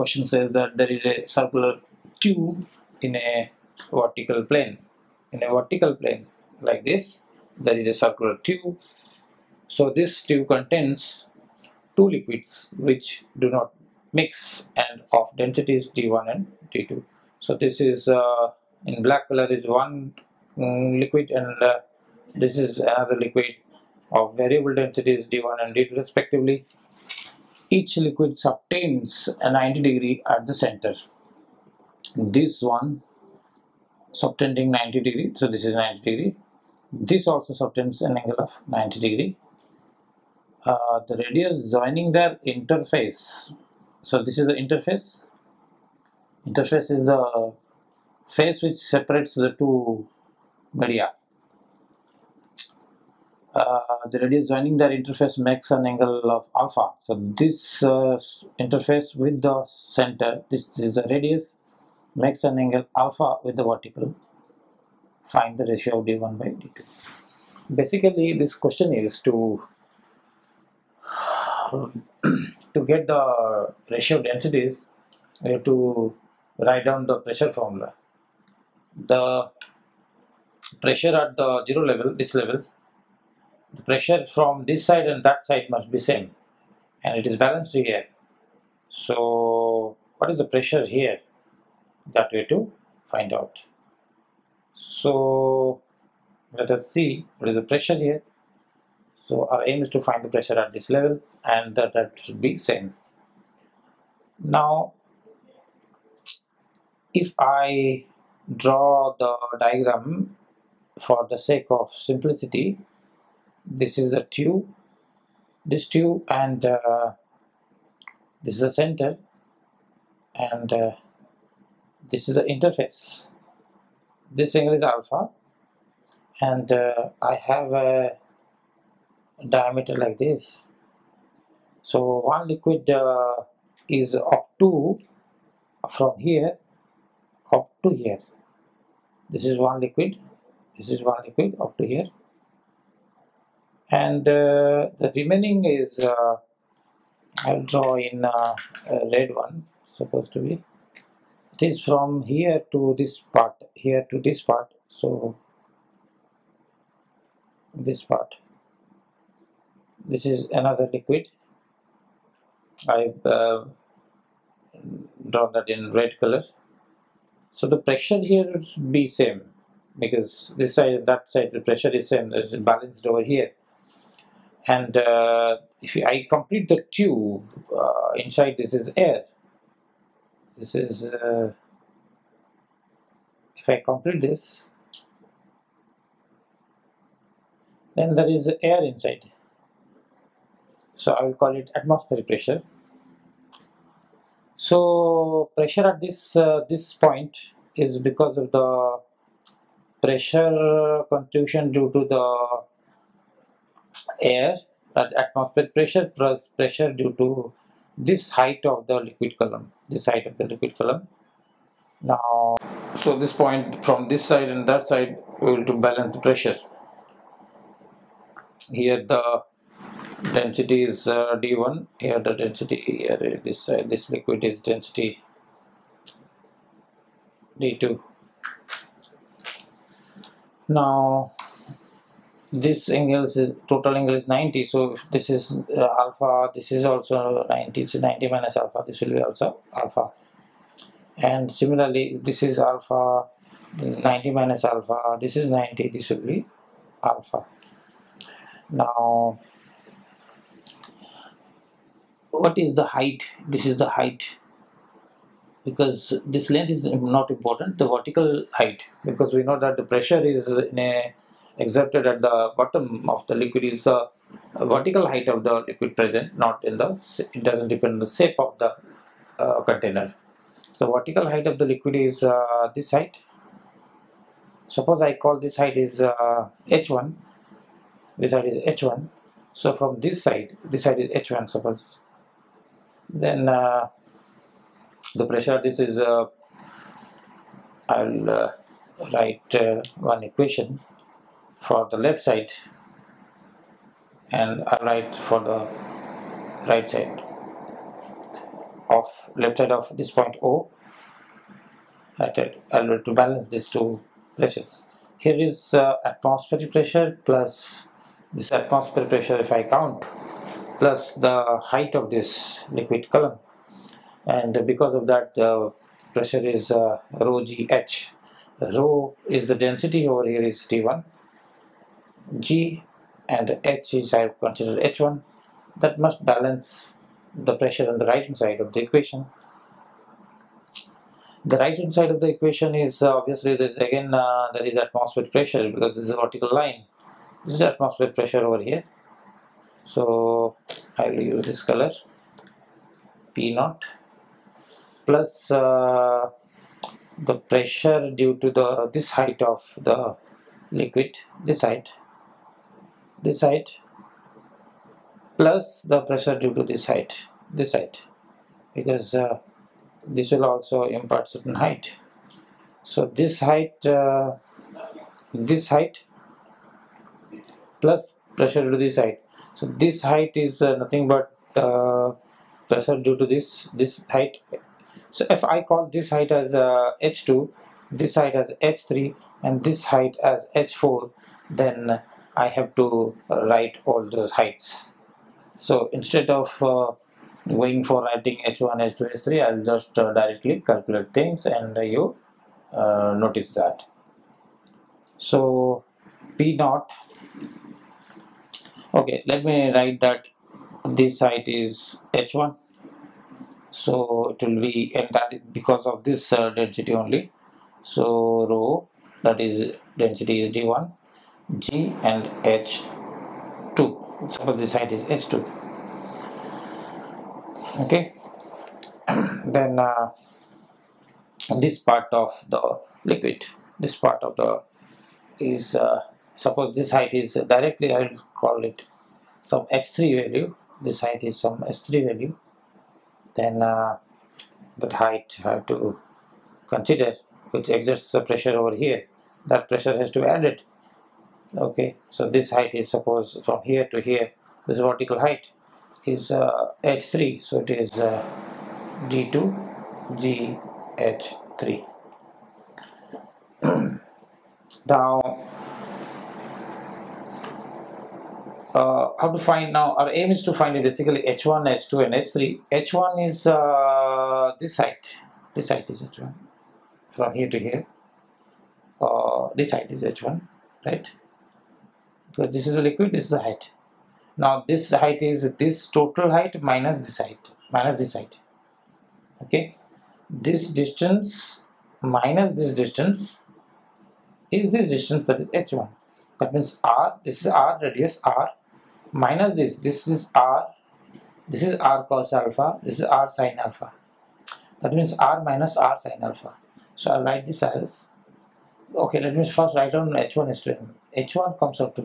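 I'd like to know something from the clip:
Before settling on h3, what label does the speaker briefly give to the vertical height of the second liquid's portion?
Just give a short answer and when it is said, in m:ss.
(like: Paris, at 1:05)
x3, at 7:09.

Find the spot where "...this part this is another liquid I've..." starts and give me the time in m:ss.
2:37.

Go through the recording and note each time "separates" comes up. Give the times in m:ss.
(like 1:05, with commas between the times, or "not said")
0:48.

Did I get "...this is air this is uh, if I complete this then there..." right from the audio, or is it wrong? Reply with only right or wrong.
right.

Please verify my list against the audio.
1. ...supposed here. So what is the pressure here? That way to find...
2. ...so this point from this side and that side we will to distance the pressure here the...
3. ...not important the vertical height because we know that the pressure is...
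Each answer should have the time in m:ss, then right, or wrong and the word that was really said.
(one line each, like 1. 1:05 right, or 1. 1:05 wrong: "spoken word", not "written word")
1. 1:27 wrong: "balanced", not "supposed"
2. 3:32 wrong: "balance", not "distance"
3. 4:17 right.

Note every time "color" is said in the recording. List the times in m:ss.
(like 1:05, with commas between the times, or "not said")
0:19, 2:46, 5:41.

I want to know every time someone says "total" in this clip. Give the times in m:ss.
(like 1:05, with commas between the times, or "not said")
3:53, 7:55.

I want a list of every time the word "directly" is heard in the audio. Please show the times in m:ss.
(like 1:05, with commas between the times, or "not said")
6:30, 7:07.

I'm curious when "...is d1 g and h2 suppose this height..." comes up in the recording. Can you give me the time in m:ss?
6:50.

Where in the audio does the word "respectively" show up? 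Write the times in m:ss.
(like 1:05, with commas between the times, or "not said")
0:25.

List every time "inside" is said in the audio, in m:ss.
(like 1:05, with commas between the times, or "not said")
2:58, 3:08.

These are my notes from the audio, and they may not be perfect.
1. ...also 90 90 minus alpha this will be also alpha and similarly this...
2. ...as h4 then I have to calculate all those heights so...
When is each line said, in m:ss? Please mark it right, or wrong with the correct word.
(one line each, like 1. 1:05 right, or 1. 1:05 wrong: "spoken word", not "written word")
1. 3:56 right
2. 6:20 wrong: "write", not "calculate".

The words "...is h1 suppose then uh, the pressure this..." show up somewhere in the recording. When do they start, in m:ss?
4:41.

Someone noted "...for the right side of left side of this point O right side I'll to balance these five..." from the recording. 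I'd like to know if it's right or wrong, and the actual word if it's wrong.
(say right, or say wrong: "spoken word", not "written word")
wrong: "two", not "five".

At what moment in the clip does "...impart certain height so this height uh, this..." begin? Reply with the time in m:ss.
6:00.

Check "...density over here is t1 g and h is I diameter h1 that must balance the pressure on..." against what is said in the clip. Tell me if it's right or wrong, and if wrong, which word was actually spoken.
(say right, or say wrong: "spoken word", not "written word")
wrong: "consider", not "diameter".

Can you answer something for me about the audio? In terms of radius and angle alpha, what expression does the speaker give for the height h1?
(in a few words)
r minus r sin alpha.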